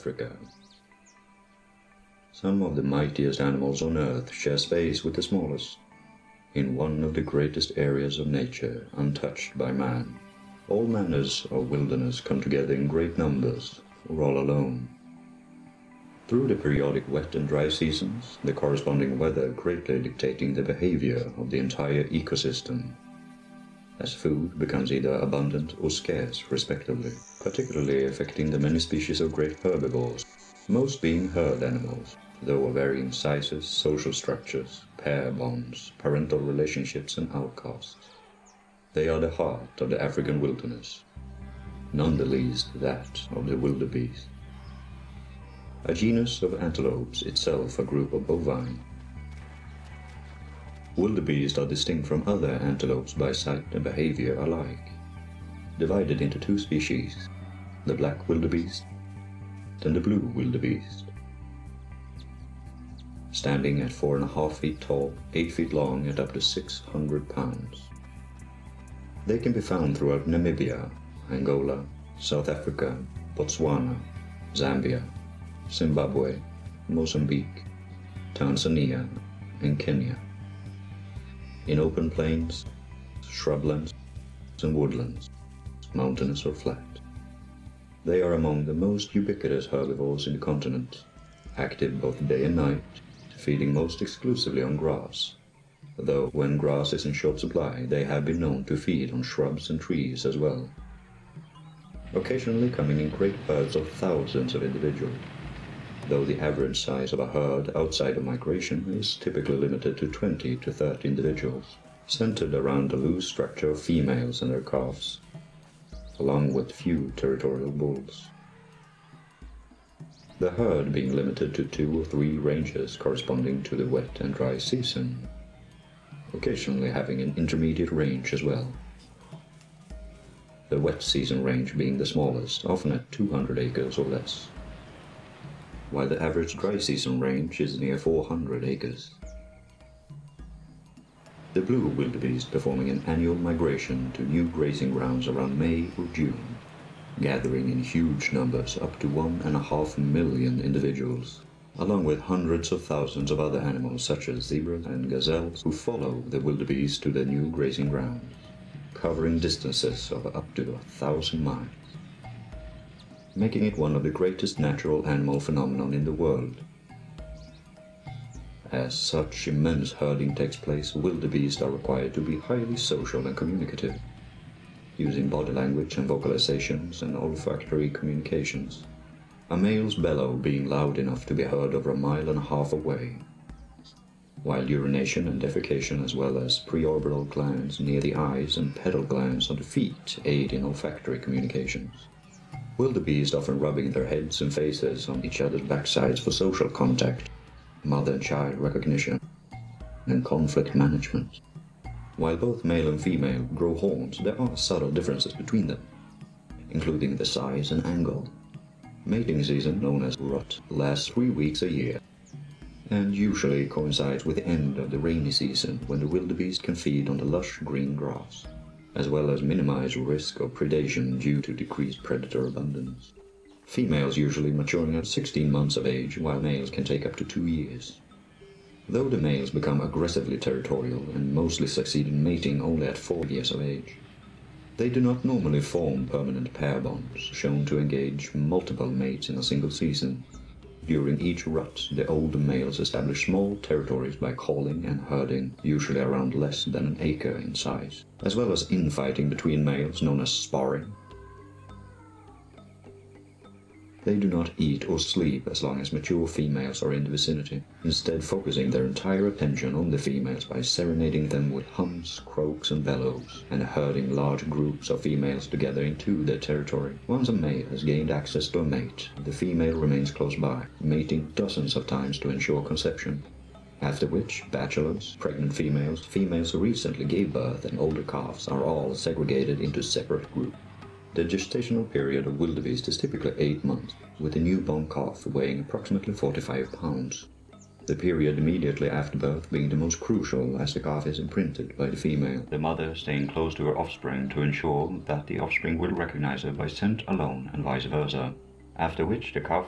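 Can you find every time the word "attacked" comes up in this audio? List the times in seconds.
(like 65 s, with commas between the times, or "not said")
not said.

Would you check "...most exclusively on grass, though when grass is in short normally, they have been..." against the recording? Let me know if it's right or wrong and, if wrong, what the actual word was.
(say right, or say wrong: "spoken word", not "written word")
wrong: "supply", not "normally".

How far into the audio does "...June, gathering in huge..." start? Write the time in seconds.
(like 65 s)
146 s.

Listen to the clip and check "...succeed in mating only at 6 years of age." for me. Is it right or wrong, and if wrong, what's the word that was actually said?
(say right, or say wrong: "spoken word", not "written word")
wrong: "4", not "6".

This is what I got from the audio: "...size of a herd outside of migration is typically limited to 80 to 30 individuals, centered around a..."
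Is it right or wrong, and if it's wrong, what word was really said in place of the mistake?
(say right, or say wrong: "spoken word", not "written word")
wrong: "20", not "80".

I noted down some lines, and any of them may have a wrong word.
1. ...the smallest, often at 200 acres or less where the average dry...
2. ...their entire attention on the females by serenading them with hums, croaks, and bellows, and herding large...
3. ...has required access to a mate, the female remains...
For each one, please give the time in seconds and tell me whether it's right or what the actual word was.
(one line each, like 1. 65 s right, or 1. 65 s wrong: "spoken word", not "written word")
1. 131 s right
2. 258 s right
3. 267 s wrong: "gained", not "required".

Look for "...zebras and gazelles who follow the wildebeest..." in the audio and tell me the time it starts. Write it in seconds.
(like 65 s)
154 s.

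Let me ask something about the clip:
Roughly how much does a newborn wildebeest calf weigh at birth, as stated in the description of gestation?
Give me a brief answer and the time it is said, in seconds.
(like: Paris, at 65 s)
45 pounds, at 286 s.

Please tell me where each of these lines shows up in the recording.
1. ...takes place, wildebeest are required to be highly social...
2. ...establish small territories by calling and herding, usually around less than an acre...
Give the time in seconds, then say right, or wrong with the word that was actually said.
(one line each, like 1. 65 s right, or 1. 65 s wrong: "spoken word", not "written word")
1. 170 s right
2. 242 s right.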